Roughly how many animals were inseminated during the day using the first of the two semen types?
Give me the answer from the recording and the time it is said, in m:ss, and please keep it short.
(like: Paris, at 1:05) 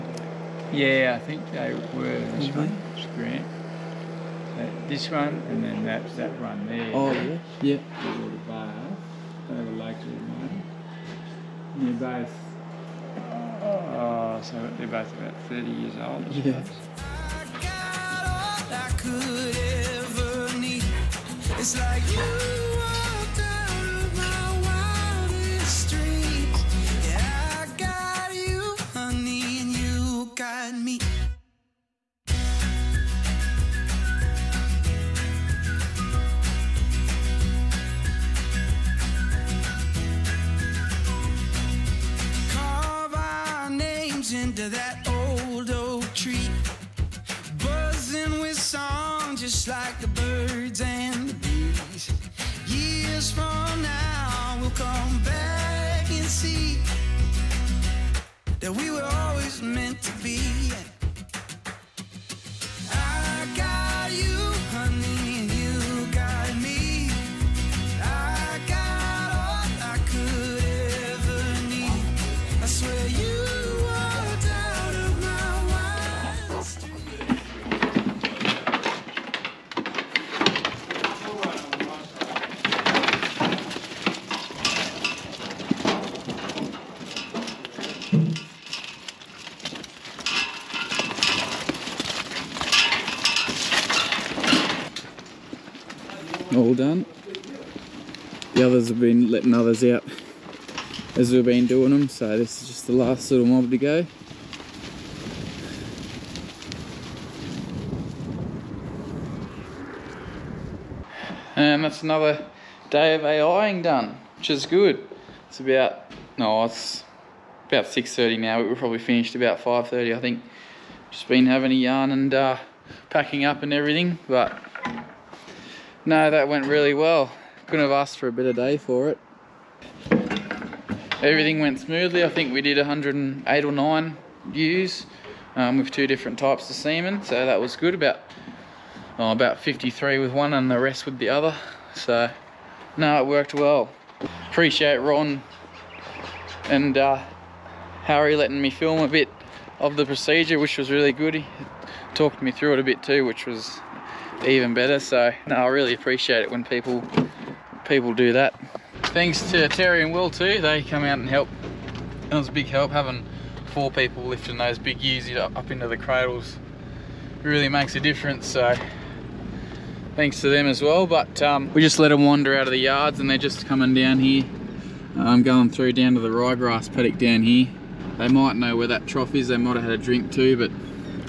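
53, at 2:19.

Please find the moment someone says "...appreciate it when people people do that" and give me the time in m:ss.
2:35.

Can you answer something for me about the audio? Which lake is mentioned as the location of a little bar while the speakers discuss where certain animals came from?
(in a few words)
Lake Lemon.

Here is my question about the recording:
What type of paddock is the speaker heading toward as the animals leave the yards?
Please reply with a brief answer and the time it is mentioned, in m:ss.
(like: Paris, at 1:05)
ryegrass, at 2:56.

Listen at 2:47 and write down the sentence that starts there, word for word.
Really makes a difference, so thanks to them as well.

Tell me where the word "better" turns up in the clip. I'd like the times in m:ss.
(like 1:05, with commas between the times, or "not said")
2:08, 2:34.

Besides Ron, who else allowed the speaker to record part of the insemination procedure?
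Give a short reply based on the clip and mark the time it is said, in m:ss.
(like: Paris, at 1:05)
Harry, at 2:28.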